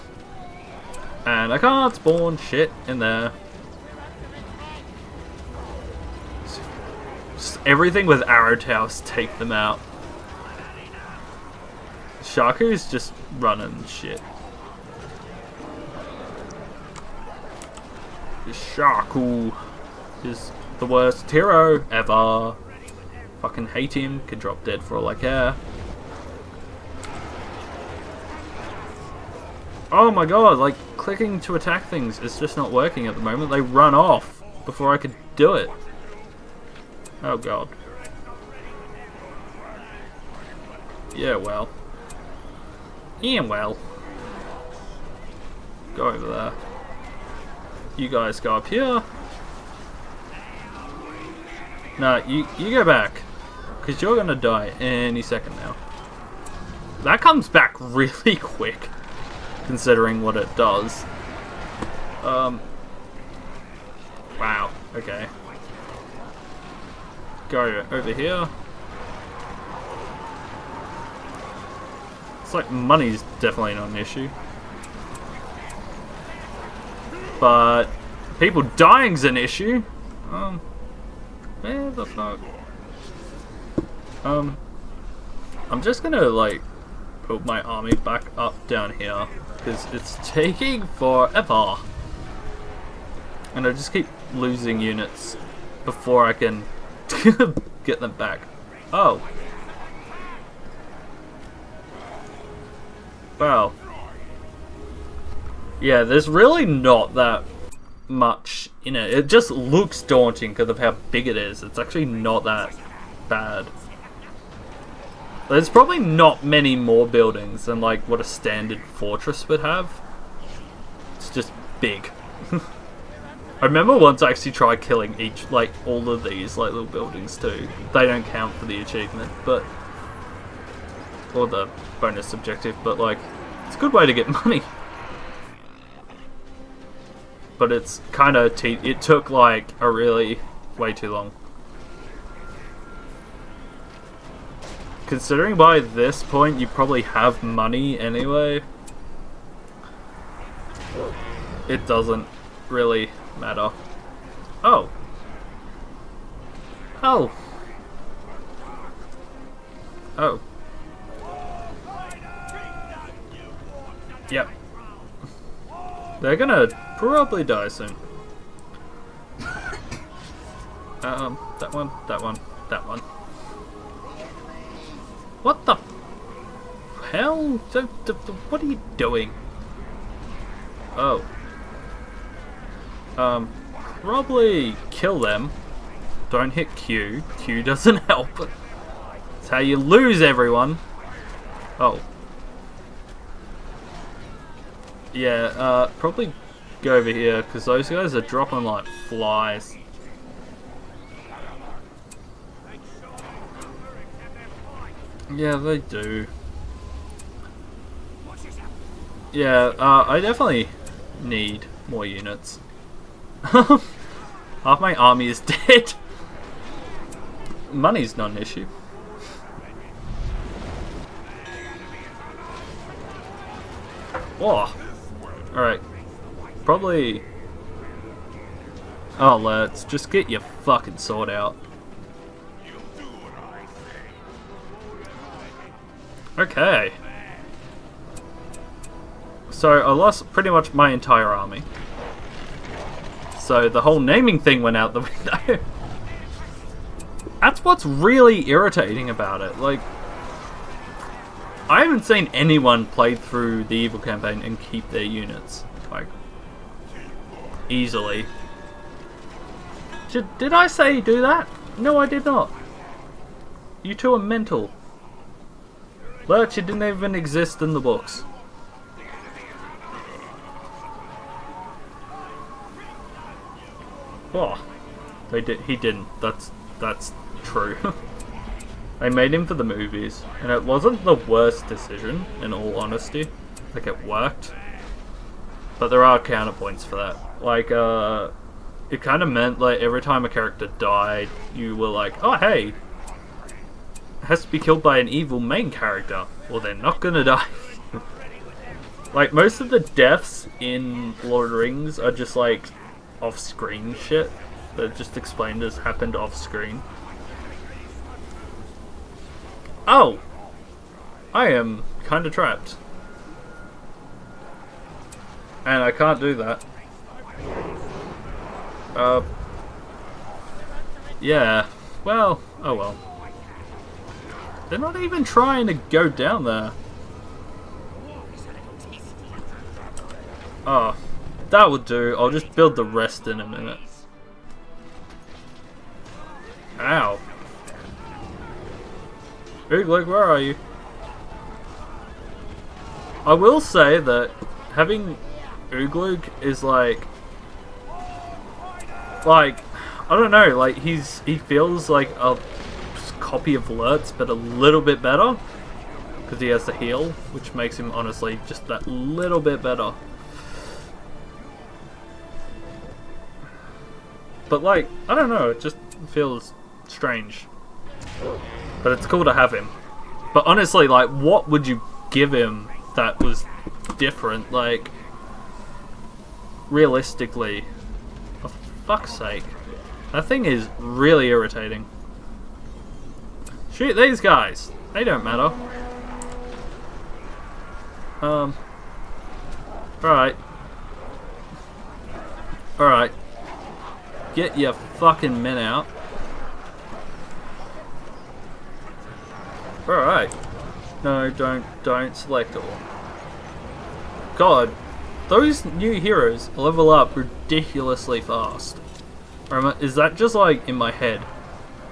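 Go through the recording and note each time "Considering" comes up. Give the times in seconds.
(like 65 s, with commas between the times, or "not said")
59 s, 145 s.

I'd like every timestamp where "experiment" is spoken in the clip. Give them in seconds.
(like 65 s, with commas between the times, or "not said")
not said.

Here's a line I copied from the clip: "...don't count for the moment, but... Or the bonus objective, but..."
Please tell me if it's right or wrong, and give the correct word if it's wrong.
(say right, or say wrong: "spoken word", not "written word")
wrong: "achievement", not "moment".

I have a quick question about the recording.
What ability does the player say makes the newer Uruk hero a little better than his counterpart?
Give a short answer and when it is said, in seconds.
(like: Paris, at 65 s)
The heal, at 356 s.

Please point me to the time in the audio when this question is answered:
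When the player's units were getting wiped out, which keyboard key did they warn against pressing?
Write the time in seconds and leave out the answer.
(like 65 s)
186 s.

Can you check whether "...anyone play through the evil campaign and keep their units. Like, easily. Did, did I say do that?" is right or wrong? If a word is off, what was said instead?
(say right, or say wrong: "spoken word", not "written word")
right.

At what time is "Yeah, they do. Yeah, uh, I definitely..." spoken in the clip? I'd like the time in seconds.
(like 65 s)
205 s.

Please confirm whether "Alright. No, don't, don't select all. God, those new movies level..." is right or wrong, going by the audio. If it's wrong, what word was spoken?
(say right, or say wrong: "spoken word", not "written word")
wrong: "heroes", not "movies".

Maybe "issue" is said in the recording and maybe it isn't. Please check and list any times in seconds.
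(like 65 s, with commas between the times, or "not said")
73 s, 79 s, 218 s.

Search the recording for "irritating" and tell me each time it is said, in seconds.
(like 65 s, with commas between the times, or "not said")
248 s, 381 s.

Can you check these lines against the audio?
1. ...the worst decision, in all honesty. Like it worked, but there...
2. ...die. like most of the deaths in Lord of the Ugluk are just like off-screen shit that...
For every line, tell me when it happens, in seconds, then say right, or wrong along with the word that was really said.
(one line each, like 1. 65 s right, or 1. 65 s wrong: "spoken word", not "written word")
1. 281 s right
2. 297 s wrong: "Rings", not "Ugluk".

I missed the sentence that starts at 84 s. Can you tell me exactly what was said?
Um, I'm just gonna like put my army back up down here because it's taking forever.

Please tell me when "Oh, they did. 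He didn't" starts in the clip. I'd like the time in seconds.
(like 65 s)
274 s.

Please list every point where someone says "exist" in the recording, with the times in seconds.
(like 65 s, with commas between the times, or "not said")
267 s.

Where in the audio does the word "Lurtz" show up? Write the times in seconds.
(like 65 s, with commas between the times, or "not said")
266 s, 353 s.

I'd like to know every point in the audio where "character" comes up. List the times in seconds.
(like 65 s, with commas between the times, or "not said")
290 s, 295 s.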